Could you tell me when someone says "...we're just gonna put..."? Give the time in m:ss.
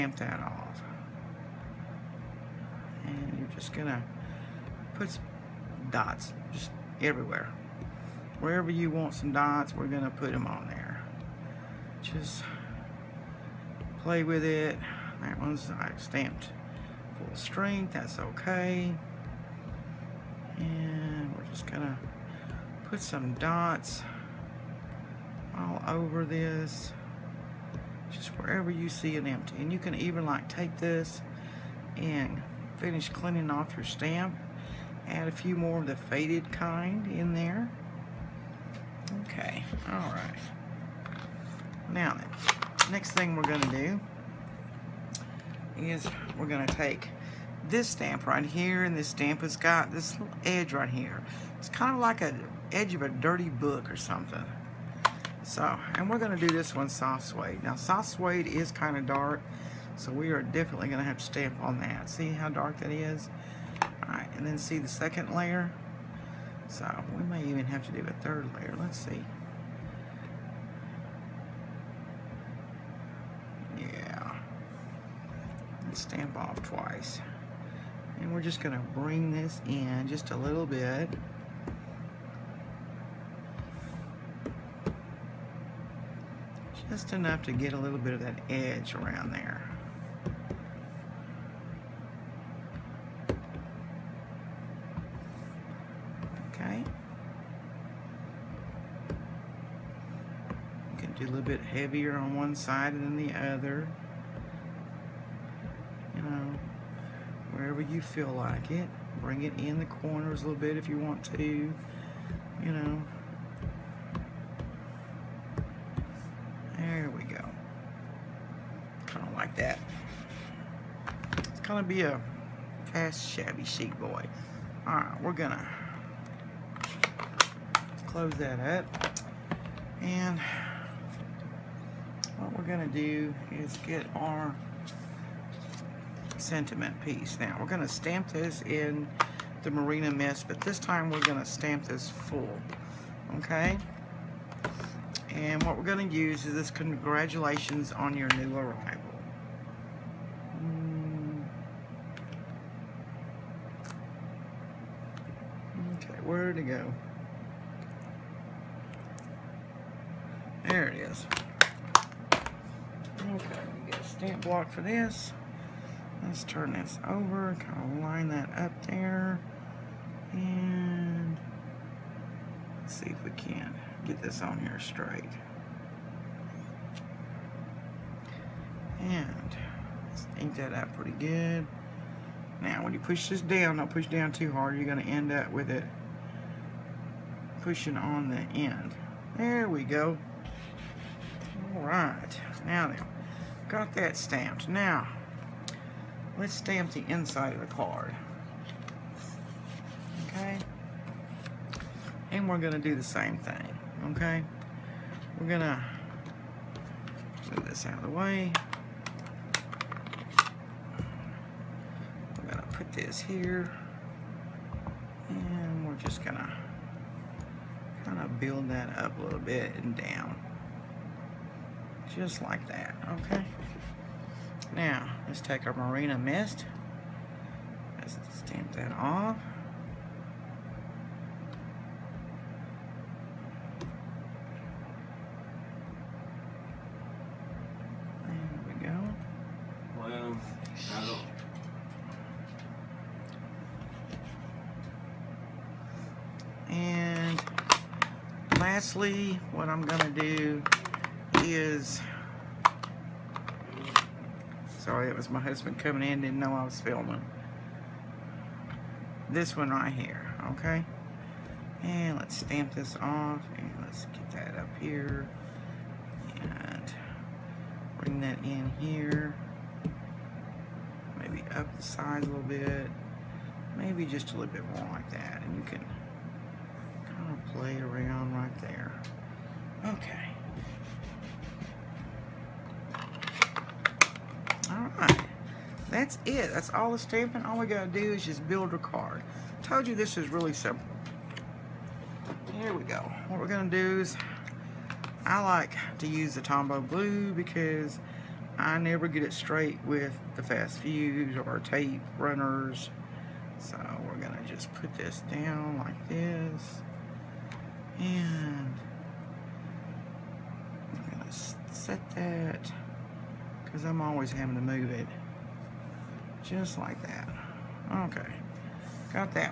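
0:21.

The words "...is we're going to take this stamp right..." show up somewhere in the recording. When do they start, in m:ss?
0:45.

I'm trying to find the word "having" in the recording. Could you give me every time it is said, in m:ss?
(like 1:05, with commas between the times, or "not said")
5:14.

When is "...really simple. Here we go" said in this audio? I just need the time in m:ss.
4:50.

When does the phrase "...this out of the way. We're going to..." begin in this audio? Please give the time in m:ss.
3:27.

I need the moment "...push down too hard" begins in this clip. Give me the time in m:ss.
3:03.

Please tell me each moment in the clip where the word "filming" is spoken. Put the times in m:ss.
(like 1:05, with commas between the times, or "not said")
4:16.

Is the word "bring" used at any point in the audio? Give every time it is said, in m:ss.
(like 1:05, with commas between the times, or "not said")
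1:18, 1:49, 4:27.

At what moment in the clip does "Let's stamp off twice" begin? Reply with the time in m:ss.
1:15.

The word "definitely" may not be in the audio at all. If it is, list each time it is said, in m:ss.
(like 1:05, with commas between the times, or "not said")
1:00.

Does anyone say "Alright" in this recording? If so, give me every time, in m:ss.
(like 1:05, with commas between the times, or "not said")
2:04, 3:11, 4:44.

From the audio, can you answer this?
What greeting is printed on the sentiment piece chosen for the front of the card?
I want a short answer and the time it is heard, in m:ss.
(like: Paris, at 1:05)
Congratulations on your new arrival, at 2:26.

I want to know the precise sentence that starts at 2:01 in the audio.
be a fast, shabby chic boy.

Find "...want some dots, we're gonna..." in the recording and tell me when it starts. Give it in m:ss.
0:08.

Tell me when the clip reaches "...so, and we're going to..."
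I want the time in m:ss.
0:55.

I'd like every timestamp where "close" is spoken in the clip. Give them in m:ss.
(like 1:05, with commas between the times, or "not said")
2:08.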